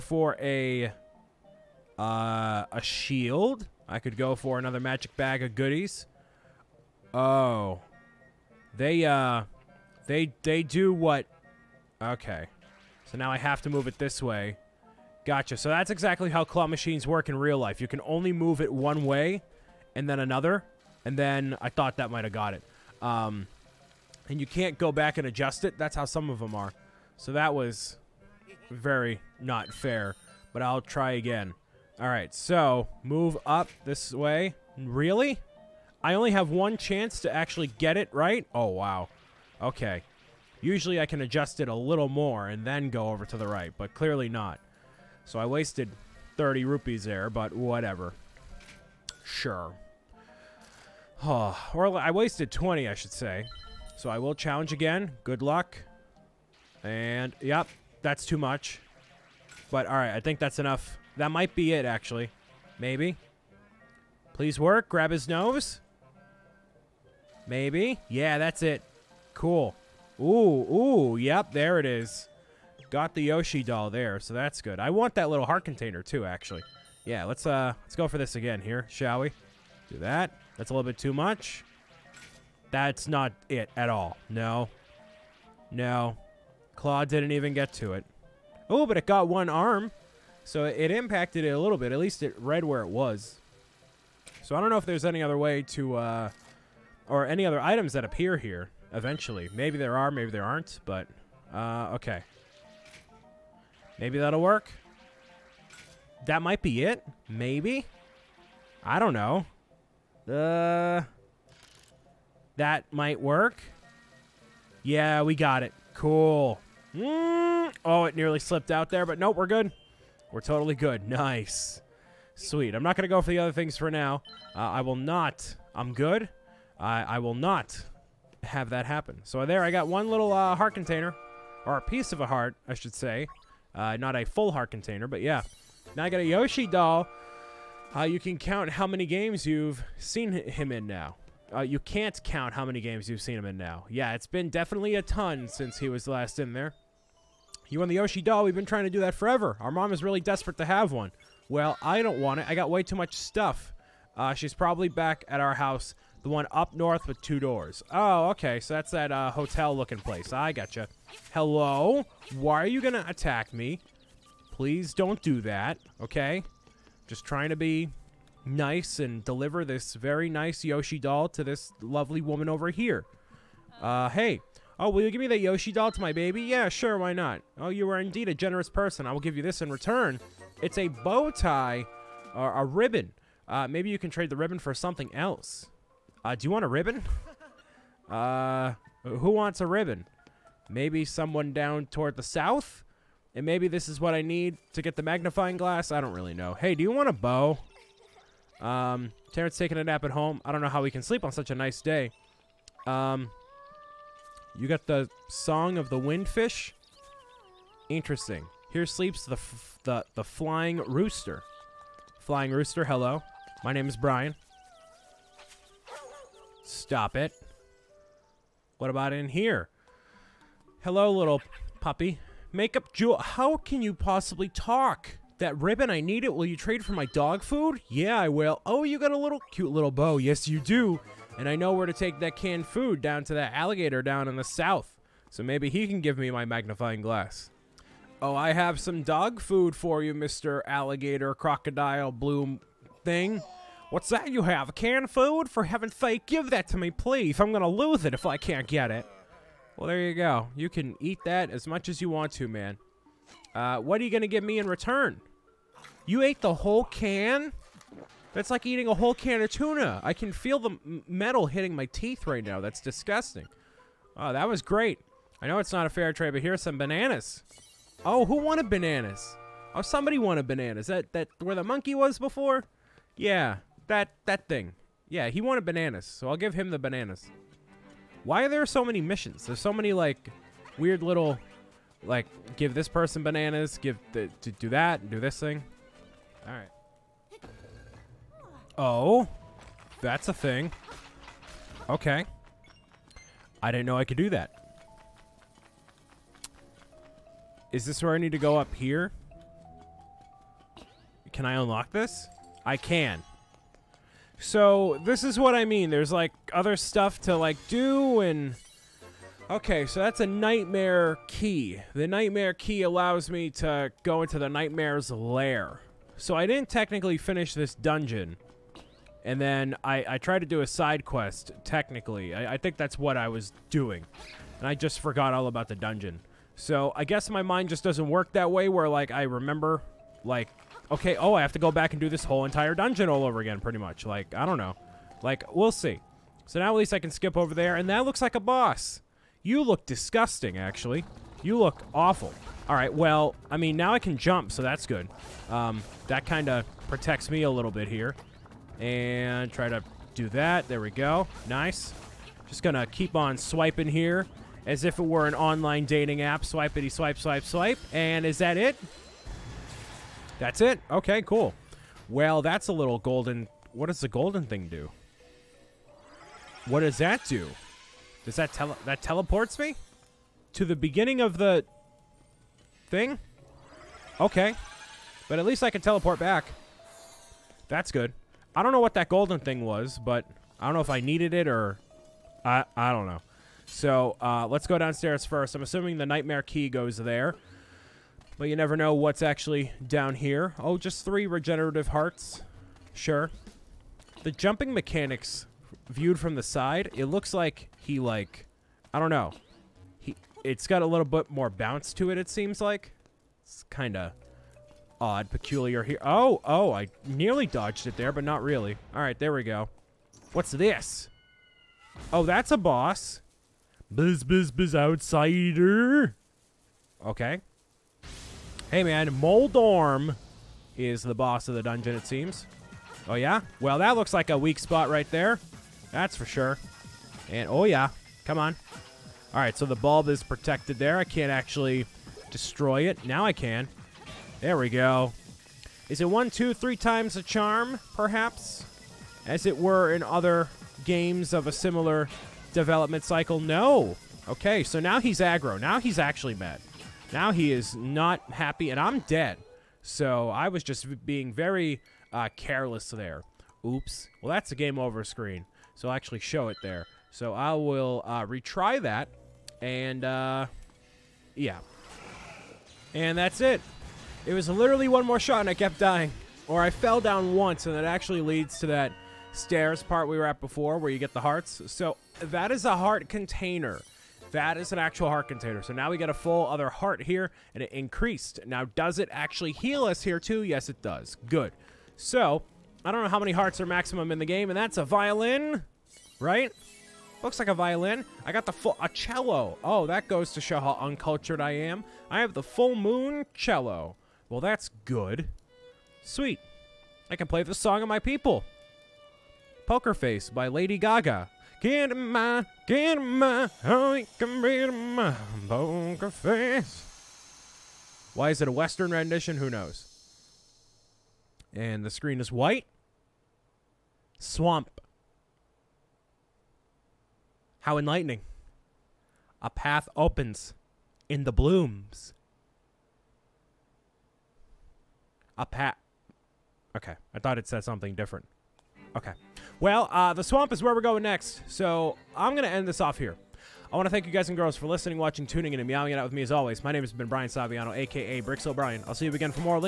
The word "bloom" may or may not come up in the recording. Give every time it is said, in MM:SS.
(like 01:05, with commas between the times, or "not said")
04:02, 08:41.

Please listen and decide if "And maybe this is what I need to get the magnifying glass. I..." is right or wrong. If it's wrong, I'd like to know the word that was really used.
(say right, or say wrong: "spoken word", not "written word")
right.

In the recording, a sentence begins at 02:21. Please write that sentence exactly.
Uh, you can't count how many games you've seen him in now.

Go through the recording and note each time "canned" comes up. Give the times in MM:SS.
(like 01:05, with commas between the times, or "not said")
03:52, 04:04.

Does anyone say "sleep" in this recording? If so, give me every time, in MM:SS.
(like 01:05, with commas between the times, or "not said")
03:21, 03:28.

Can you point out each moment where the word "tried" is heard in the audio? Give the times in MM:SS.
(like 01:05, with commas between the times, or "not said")
05:20.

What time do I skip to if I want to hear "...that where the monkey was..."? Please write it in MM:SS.
04:31.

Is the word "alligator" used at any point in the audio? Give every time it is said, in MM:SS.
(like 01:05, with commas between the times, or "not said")
03:53, 04:00.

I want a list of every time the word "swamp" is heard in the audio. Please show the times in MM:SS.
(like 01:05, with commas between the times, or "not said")
08:34, 08:50.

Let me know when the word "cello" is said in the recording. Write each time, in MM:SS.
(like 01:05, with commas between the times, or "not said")
08:08, 08:13.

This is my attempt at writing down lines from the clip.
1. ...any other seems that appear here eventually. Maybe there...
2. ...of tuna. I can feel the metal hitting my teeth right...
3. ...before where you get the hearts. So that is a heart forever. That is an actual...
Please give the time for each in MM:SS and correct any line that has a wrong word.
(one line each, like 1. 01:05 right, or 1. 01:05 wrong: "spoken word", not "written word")
1. 01:37 wrong: "items", not "seems"
2. 04:19 right
3. 07:50 wrong: "container", not "forever".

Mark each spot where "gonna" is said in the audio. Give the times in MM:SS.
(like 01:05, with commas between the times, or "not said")
04:07.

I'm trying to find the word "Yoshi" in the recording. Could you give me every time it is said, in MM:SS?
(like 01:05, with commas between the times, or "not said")
01:13, 02:16, 02:27, 02:50, 02:55.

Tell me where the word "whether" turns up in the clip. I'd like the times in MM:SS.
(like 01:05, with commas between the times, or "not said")
not said.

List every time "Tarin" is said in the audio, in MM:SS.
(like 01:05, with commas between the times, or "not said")
03:19.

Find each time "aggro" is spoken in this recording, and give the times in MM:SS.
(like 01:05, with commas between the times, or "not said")
07:25.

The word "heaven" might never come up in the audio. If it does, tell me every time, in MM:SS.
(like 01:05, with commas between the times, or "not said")
04:05.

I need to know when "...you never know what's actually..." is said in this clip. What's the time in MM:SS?
06:28.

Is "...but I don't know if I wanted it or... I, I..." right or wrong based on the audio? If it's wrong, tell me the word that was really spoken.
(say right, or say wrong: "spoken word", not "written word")
wrong: "needed", not "wanted".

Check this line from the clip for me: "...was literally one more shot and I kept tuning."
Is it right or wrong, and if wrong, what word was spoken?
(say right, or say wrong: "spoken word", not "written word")
wrong: "dying", not "tuning".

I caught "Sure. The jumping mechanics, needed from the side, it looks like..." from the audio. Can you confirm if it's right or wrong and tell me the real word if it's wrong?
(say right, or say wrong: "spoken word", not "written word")
wrong: "viewed", not "needed".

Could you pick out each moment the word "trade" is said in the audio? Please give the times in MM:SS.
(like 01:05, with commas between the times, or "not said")
03:04, 03:46, 04:26.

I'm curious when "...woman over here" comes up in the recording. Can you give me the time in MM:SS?
02:52.